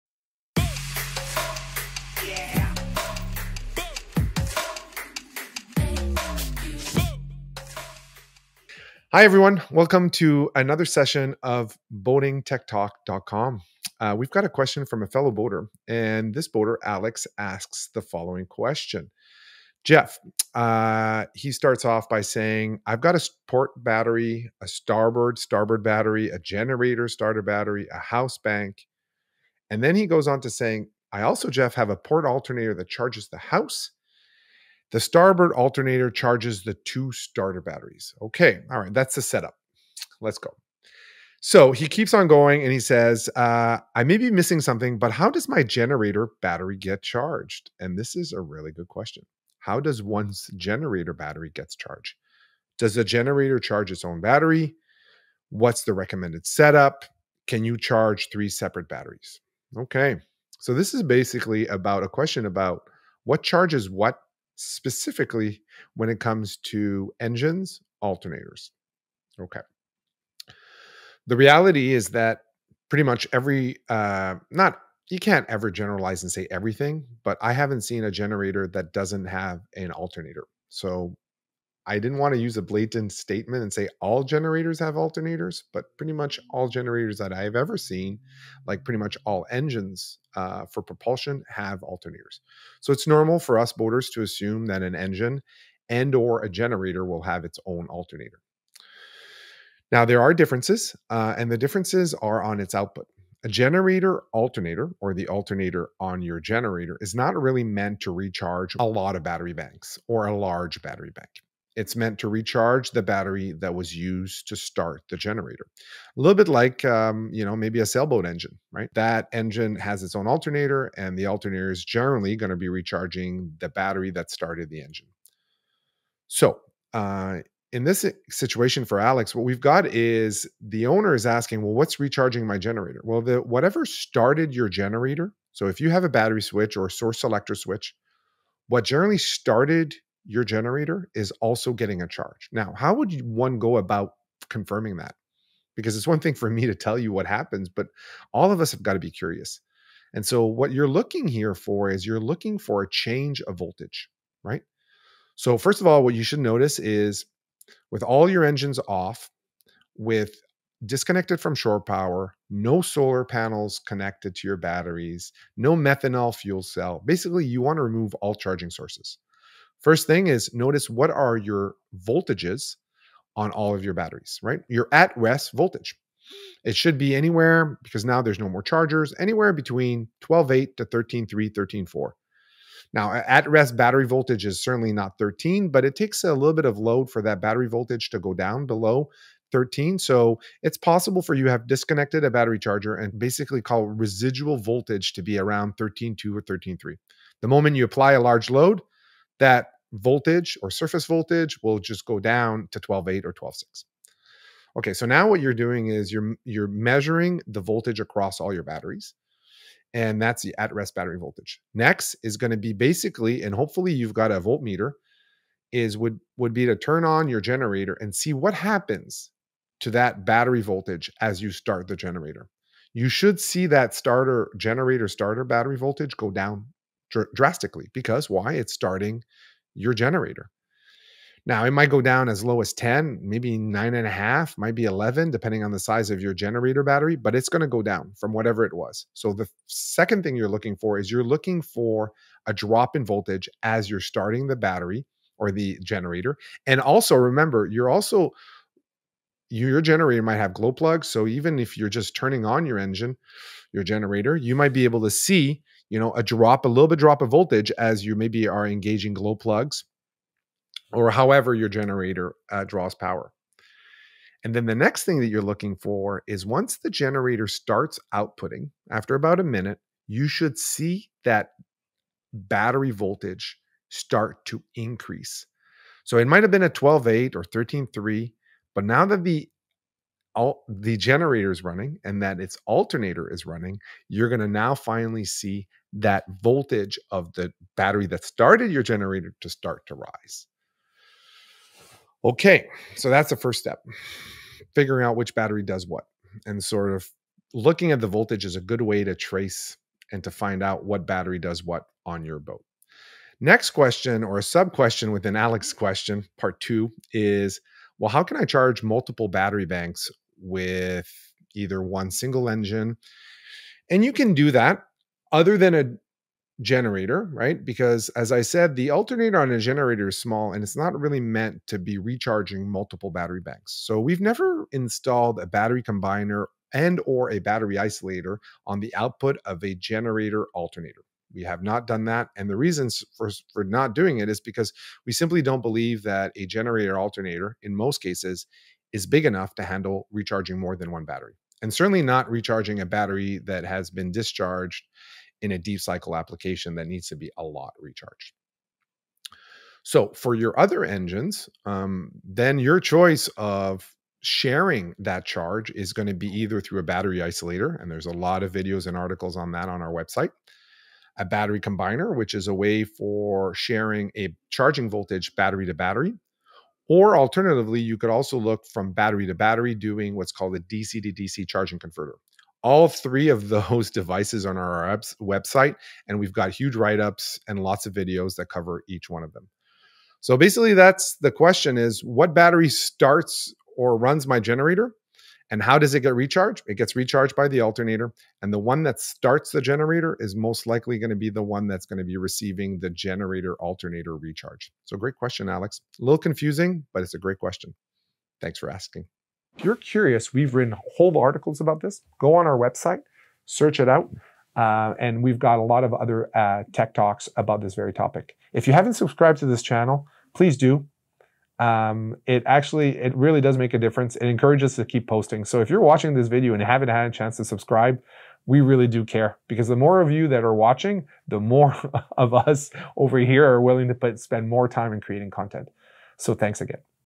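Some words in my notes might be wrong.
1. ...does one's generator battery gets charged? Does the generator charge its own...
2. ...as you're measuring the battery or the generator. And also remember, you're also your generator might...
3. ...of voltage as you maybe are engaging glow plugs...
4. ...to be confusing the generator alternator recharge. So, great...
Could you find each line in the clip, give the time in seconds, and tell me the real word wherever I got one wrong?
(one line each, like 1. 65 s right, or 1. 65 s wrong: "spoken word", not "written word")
1. 49 s right
2. 243 s wrong: "starting", not "measuring"
3. 257 s right
4. 391 s wrong: "receiving", not "confusing".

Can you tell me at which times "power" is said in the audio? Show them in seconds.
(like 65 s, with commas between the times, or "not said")
161 s, 262 s.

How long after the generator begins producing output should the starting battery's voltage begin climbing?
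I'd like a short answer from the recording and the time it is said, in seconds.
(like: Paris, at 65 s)
About a minute, at 269 s.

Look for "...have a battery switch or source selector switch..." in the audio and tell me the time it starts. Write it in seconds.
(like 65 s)
135 s.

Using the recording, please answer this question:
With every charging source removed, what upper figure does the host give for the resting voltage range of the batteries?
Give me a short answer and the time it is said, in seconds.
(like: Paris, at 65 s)
13.4, at 181 s.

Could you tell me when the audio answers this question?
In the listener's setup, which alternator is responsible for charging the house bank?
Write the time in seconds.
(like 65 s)
31 s.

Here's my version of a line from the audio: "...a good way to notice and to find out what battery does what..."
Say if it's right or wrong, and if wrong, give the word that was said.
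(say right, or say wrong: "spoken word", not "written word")
wrong: "trace", not "notice".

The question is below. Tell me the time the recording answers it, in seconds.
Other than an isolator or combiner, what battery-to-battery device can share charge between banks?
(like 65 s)
370 s.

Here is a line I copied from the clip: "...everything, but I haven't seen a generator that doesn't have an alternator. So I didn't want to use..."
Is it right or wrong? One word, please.
right.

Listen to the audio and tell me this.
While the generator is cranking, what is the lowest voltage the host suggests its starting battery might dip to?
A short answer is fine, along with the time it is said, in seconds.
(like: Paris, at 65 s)
9.5, at 233 s.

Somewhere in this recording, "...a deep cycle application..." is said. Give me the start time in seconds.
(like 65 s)
345 s.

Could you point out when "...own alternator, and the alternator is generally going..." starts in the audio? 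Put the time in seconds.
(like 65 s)
120 s.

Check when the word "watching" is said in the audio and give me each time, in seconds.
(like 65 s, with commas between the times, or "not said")
415 s, 420 s.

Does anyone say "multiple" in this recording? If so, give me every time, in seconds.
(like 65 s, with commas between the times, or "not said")
308 s, 322 s.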